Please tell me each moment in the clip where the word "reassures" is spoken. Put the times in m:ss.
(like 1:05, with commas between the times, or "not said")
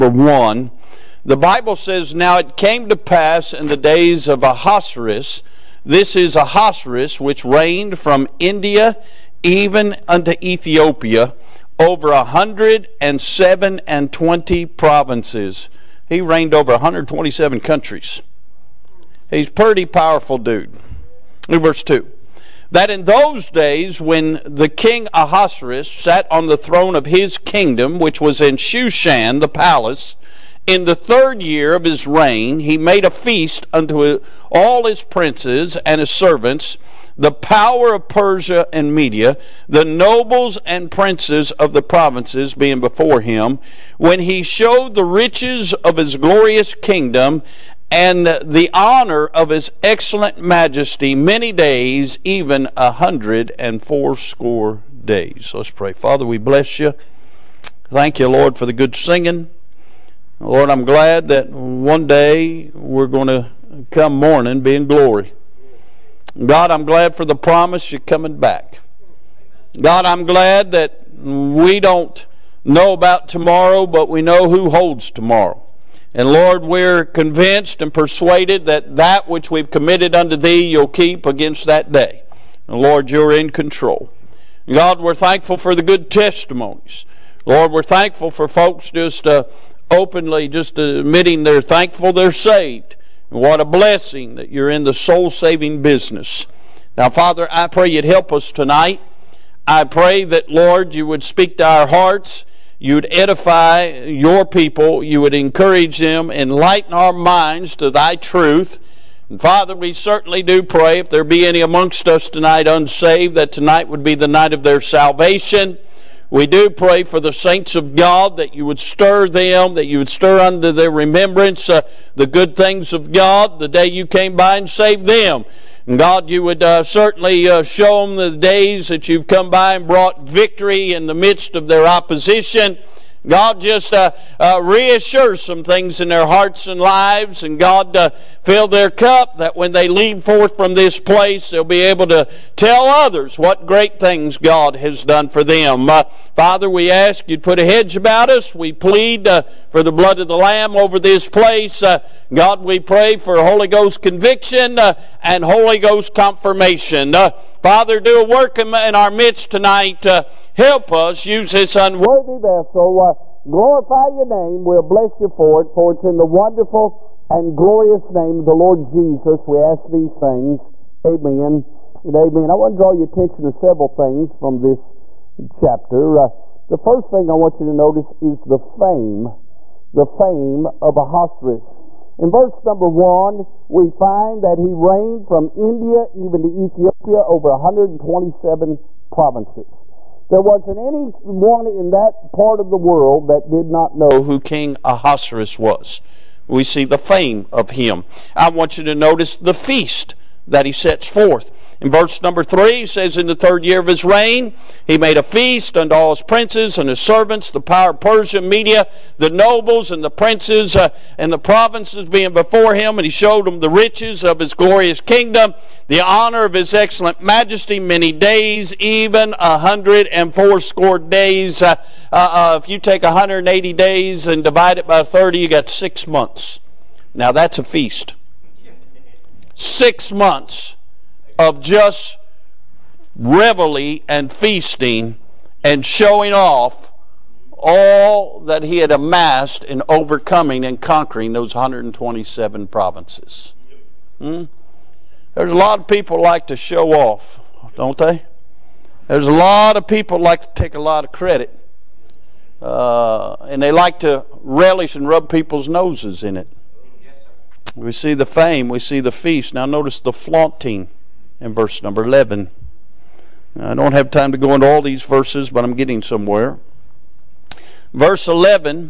2:14.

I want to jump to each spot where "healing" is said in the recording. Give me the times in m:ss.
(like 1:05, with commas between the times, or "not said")
not said.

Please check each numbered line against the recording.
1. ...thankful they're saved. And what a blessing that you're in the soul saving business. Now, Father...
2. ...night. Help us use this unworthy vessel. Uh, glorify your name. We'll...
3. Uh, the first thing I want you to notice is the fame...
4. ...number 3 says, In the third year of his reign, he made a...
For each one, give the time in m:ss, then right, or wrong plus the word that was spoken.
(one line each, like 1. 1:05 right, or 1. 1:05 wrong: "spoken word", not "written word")
1. 1:31 right
2. 2:39 wrong: "tonight", not "night"
3. 2:56 right
4. 3:22 right.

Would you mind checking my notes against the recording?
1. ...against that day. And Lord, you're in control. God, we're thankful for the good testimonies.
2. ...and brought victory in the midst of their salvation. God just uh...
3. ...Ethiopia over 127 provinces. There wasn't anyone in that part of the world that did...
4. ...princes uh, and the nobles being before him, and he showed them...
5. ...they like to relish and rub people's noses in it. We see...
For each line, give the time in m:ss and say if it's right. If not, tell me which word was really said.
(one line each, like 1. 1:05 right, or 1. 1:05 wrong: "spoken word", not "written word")
1. 1:21 right
2. 2:09 wrong: "opposition", not "salvation"
3. 3:06 right
4. 3:30 wrong: "provinces", not "nobles"
5. 4:13 right.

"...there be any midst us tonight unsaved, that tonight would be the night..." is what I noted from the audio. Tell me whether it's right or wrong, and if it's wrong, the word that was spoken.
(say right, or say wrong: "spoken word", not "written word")
wrong: "amongst", not "midst".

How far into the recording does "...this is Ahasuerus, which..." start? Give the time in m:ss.
0:05.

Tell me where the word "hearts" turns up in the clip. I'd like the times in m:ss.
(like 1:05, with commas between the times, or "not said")
1:41, 2:16.